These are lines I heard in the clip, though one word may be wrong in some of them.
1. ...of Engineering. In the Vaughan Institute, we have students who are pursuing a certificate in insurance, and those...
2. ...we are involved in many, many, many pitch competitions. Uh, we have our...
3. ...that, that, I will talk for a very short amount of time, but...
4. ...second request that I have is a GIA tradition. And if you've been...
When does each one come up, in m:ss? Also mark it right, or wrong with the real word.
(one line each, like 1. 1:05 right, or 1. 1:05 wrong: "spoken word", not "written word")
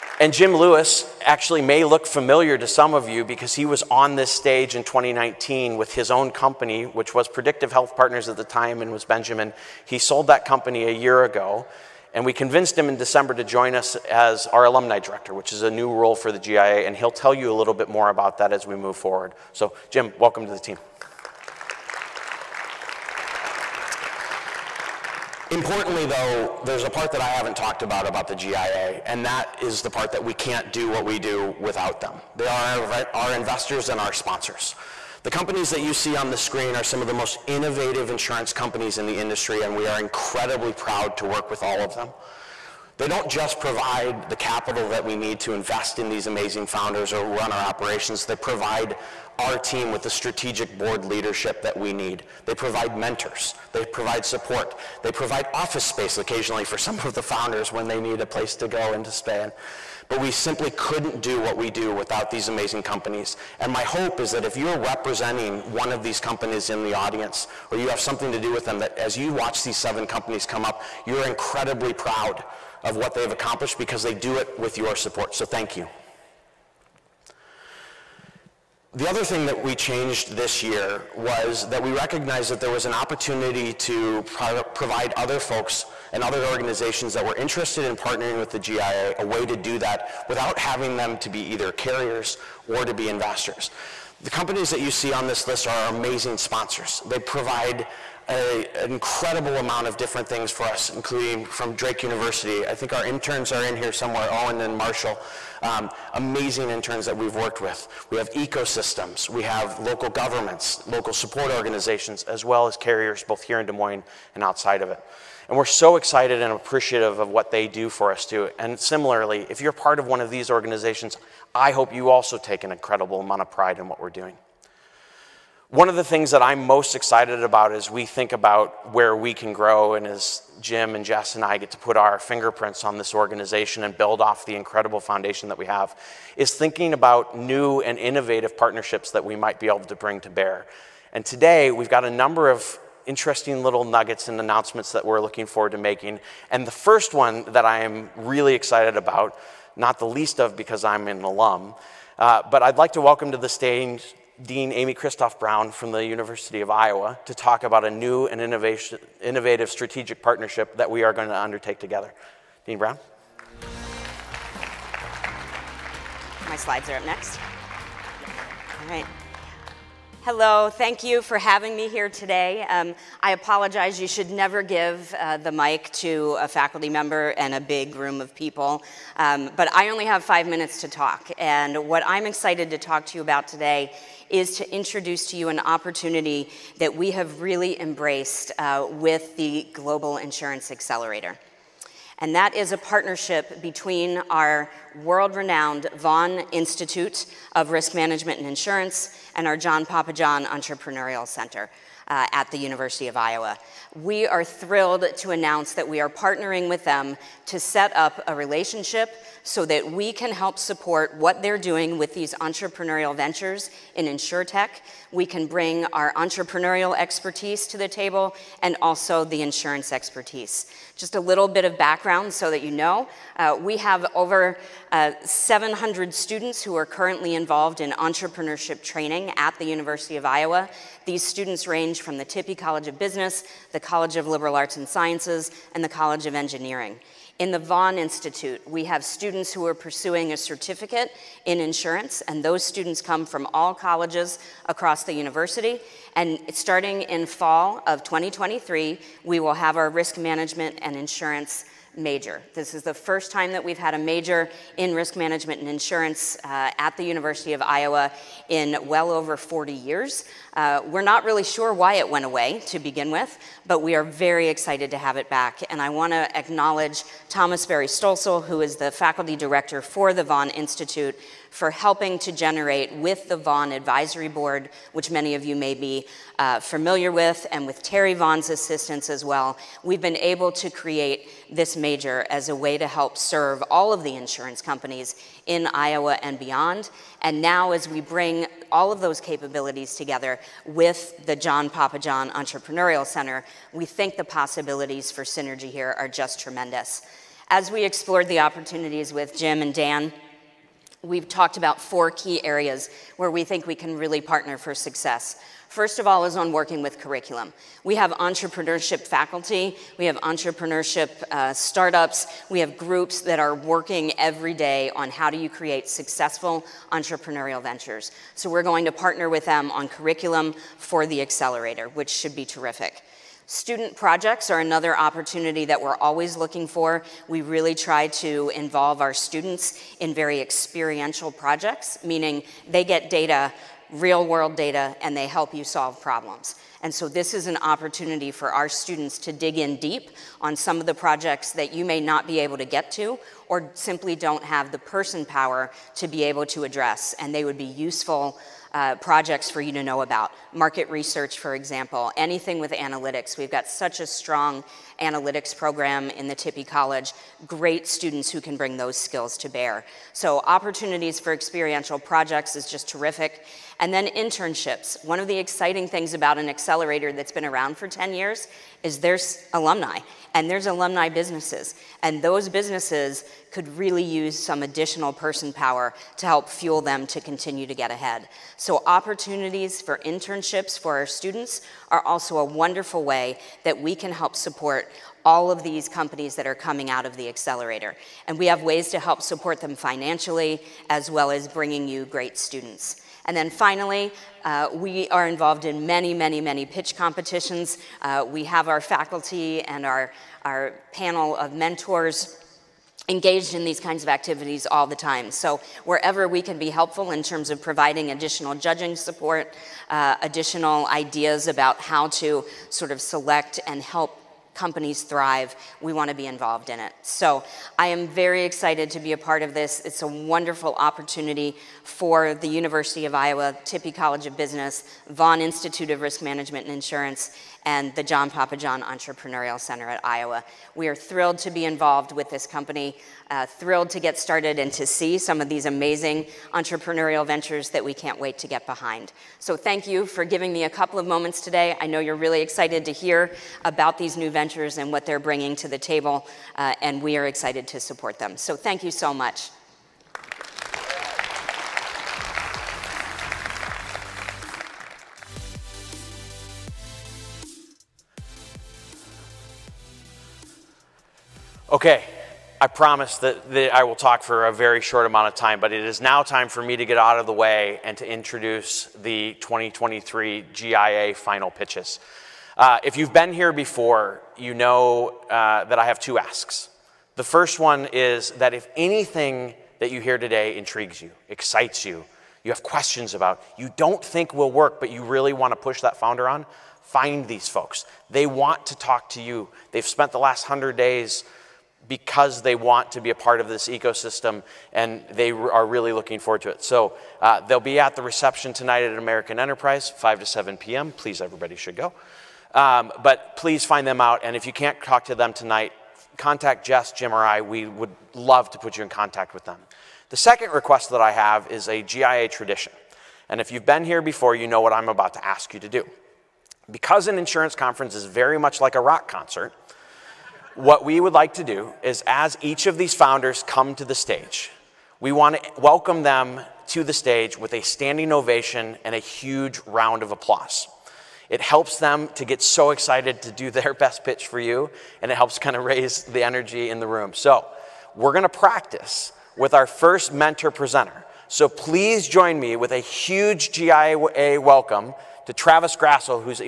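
1. 3:56 right
2. 6:34 right
3. 7:43 right
4. 8:30 right.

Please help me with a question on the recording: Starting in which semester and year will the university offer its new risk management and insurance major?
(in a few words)
fall of 2023.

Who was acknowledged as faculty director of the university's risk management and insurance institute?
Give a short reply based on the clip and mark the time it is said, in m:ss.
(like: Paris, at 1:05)
Thomas Berry Stölzle, at 4:27.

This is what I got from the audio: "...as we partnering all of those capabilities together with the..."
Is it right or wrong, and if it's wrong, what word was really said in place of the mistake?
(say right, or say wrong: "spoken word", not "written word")
wrong: "bring", not "partnering".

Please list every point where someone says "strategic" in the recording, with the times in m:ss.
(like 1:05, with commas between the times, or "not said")
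0:50, 2:39.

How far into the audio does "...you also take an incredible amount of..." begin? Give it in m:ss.
2:01.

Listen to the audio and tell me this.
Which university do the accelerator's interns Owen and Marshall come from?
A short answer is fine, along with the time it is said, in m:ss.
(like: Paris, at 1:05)
Drake University, at 1:41.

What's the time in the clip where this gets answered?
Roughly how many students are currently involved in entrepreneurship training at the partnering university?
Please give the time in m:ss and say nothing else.
3:45.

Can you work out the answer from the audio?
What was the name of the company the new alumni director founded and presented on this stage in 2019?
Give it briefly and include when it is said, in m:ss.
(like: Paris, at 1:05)
Predictive Health Partners, at 0:07.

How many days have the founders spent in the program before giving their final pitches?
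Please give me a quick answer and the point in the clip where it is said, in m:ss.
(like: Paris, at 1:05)
100, at 8:10.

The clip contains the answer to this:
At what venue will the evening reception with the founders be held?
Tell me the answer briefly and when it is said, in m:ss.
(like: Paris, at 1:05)
American Enterprise, at 8:18.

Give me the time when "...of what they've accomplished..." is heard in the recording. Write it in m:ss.
1:12.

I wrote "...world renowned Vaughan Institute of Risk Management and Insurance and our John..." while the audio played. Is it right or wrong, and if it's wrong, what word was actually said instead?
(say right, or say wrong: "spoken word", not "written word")
right.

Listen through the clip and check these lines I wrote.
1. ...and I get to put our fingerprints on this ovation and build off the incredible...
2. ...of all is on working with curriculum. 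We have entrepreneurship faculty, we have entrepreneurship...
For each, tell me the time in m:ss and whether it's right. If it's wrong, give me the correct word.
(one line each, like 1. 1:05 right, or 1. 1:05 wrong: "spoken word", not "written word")
1. 2:11 wrong: "organization", not "ovation"
2. 5:06 right.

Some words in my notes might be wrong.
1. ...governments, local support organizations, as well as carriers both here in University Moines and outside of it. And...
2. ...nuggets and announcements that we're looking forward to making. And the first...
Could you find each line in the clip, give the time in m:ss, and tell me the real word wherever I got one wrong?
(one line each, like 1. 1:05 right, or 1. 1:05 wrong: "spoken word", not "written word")
1. 1:50 wrong: "Des", not "University"
2. 2:23 right.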